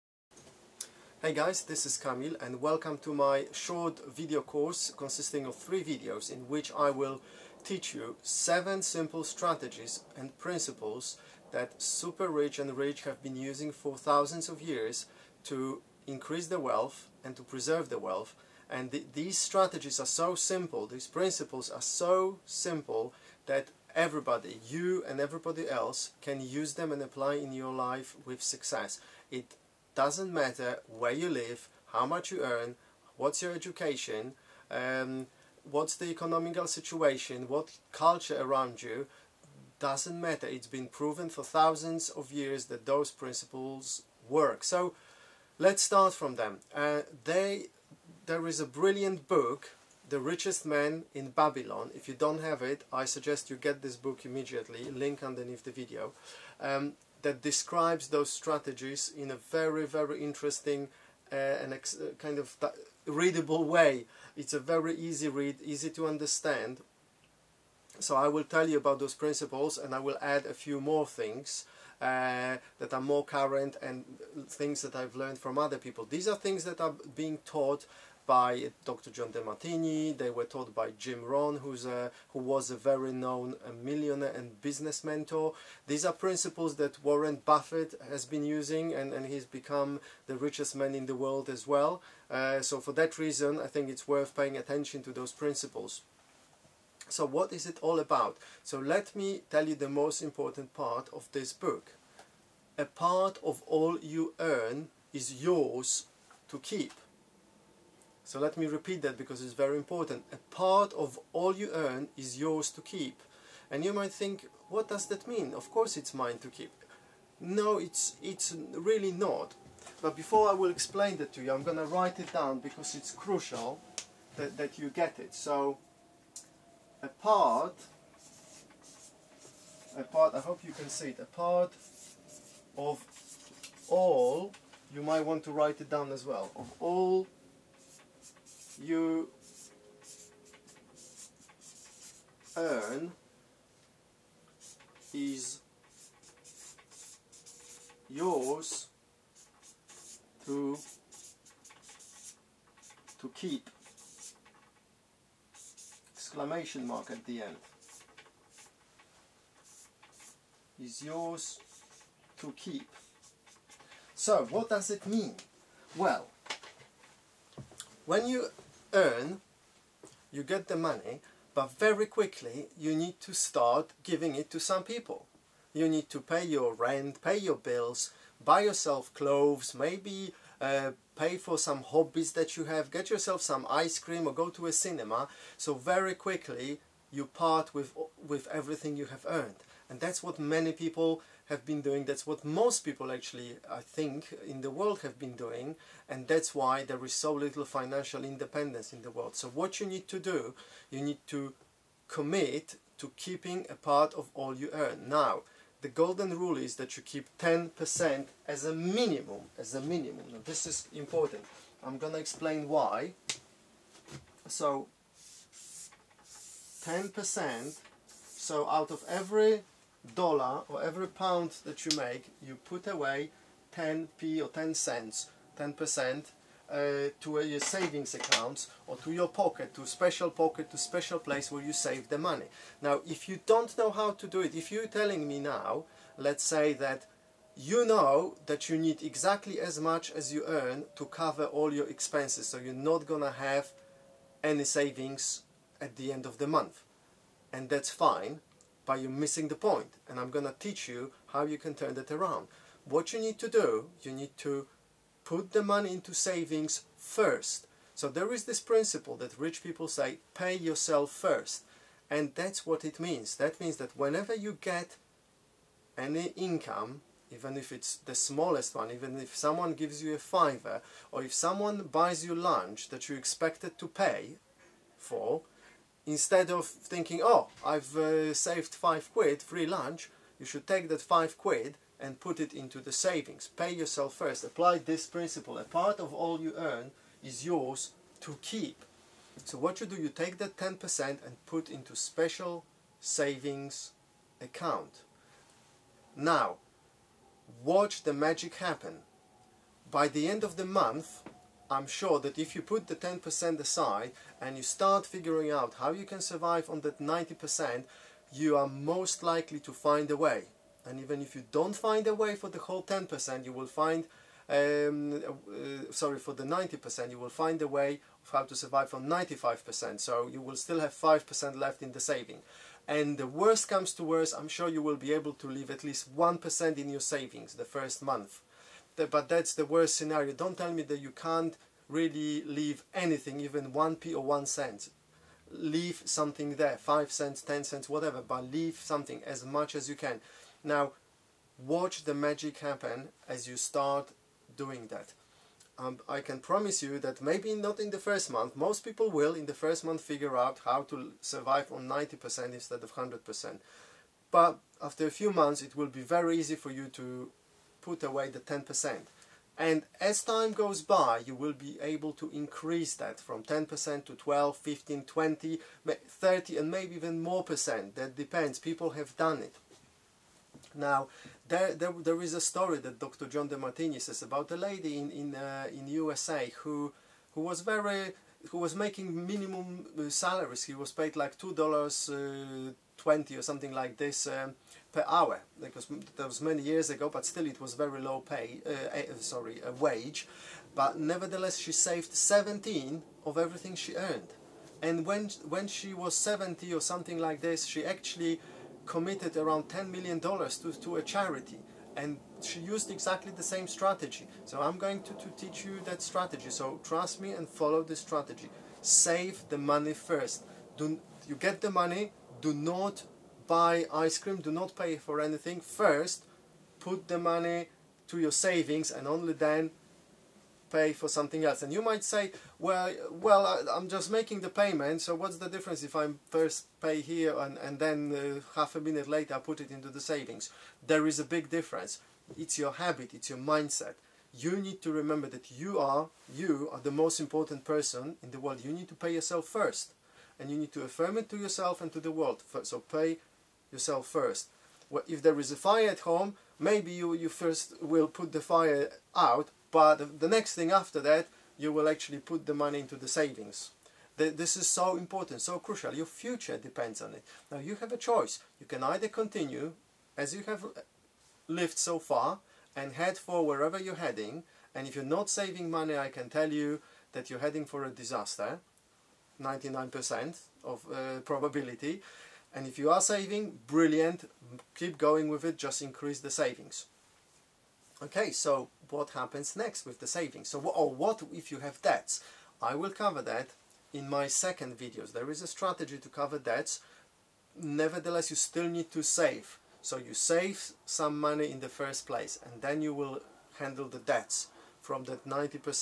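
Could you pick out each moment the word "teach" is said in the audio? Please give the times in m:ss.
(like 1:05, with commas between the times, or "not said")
0:07, 4:10, 6:45.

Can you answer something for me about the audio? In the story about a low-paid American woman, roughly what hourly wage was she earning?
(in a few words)
$2.20.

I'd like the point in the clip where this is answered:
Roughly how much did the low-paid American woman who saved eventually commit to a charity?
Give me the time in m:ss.
6:39.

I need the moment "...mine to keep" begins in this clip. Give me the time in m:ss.
1:56.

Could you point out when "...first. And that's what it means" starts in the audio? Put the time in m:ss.
4:21.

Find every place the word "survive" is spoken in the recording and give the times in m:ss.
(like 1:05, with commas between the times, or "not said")
5:06, 5:18, 5:51.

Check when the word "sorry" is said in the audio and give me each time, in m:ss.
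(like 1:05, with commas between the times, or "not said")
5:15, 6:29.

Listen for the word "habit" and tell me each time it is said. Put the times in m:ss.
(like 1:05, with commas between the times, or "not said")
7:12.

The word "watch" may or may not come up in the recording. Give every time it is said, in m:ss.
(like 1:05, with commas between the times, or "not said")
4:57, 5:41.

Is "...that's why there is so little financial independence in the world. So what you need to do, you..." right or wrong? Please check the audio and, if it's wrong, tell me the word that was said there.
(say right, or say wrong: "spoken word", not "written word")
right.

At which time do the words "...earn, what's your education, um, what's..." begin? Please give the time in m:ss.
0:32.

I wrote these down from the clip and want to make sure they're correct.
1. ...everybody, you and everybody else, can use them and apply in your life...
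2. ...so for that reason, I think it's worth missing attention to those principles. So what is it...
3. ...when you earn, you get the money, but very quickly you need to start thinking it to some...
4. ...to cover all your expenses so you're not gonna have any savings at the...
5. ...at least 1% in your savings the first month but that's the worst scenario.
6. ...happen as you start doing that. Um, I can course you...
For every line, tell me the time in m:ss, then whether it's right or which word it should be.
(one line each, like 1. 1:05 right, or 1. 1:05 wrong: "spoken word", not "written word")
1. 0:23 right
2. 1:32 wrong: "paying", not "missing"
3. 2:48 wrong: "giving", not "thinking"
4. 4:00 right
5. 5:25 right
6. 5:42 wrong: "promise", not "course".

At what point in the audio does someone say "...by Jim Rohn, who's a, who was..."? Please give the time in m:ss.
1:20.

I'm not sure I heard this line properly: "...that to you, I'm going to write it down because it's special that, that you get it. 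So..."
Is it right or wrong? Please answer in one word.
wrong.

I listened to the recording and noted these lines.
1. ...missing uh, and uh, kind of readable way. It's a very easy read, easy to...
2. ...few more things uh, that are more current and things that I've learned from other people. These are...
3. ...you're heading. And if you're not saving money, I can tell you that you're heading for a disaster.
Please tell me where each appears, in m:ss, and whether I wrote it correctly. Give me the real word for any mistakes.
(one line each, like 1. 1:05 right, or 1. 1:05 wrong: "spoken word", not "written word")
1. 1:00 wrong: "interesting", not "missing"
2. 1:10 right
3. 7:43 right.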